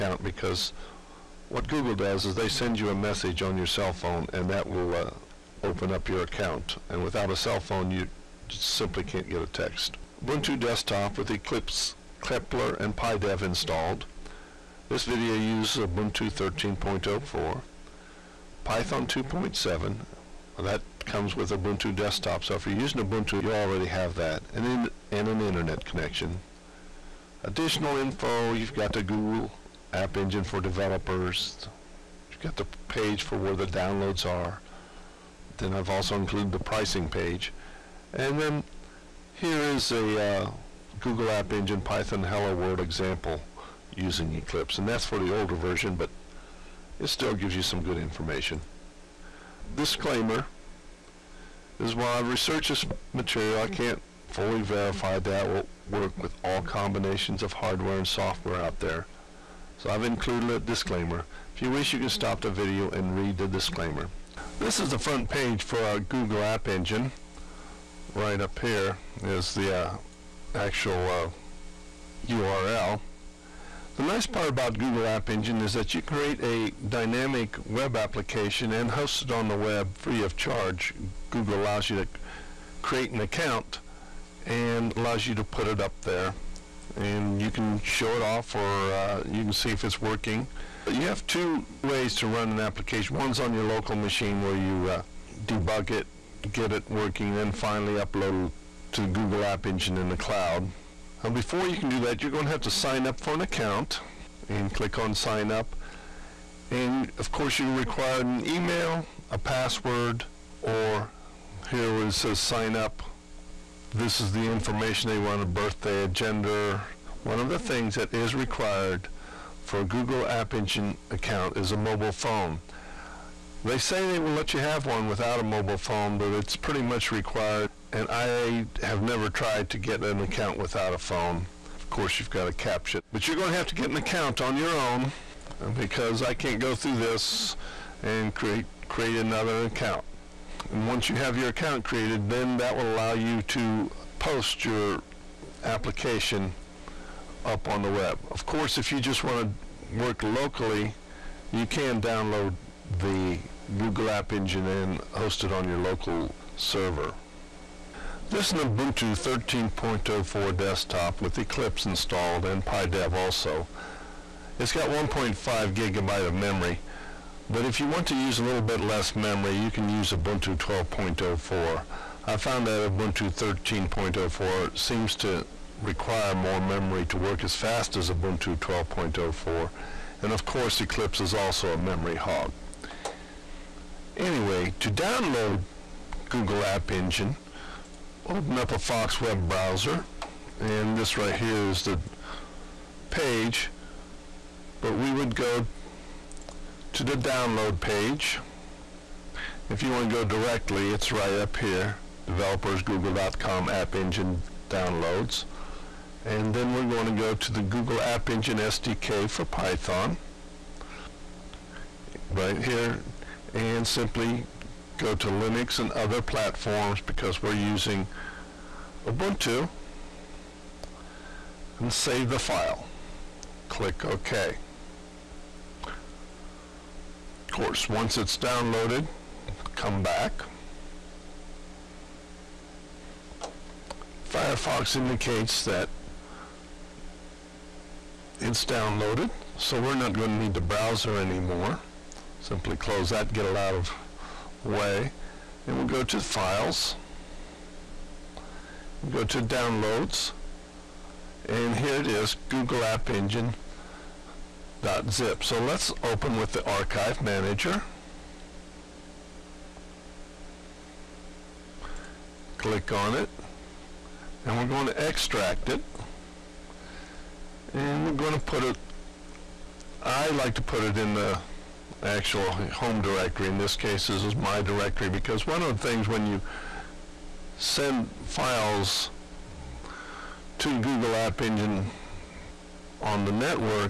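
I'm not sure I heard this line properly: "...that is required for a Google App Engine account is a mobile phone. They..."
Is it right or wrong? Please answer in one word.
right.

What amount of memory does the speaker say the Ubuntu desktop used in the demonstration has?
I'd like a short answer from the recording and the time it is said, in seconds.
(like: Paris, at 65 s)
1.5 gigabytes, at 164 s.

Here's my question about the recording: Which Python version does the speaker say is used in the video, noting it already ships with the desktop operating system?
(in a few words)
Python 2.7.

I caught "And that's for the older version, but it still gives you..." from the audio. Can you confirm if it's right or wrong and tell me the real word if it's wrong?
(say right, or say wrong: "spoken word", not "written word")
right.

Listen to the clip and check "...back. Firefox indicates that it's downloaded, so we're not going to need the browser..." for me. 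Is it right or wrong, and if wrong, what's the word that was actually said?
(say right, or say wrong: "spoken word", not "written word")
right.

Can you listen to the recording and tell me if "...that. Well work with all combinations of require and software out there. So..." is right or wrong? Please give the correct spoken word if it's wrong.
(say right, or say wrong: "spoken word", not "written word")
wrong: "hardware", not "require".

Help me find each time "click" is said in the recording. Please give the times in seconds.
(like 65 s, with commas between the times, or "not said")
104 s, 223 s, 262 s.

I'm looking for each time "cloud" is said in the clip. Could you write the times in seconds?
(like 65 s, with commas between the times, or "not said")
100 s.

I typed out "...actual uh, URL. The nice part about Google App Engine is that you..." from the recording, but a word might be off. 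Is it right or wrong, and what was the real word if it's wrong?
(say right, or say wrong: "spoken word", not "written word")
right.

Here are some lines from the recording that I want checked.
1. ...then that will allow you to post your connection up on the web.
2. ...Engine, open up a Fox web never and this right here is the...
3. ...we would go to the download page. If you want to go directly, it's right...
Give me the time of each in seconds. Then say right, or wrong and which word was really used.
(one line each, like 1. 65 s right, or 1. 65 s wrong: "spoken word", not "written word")
1. 142 s wrong: "application", not "connection"
2. 186 s wrong: "browser", not "never"
3. 194 s right.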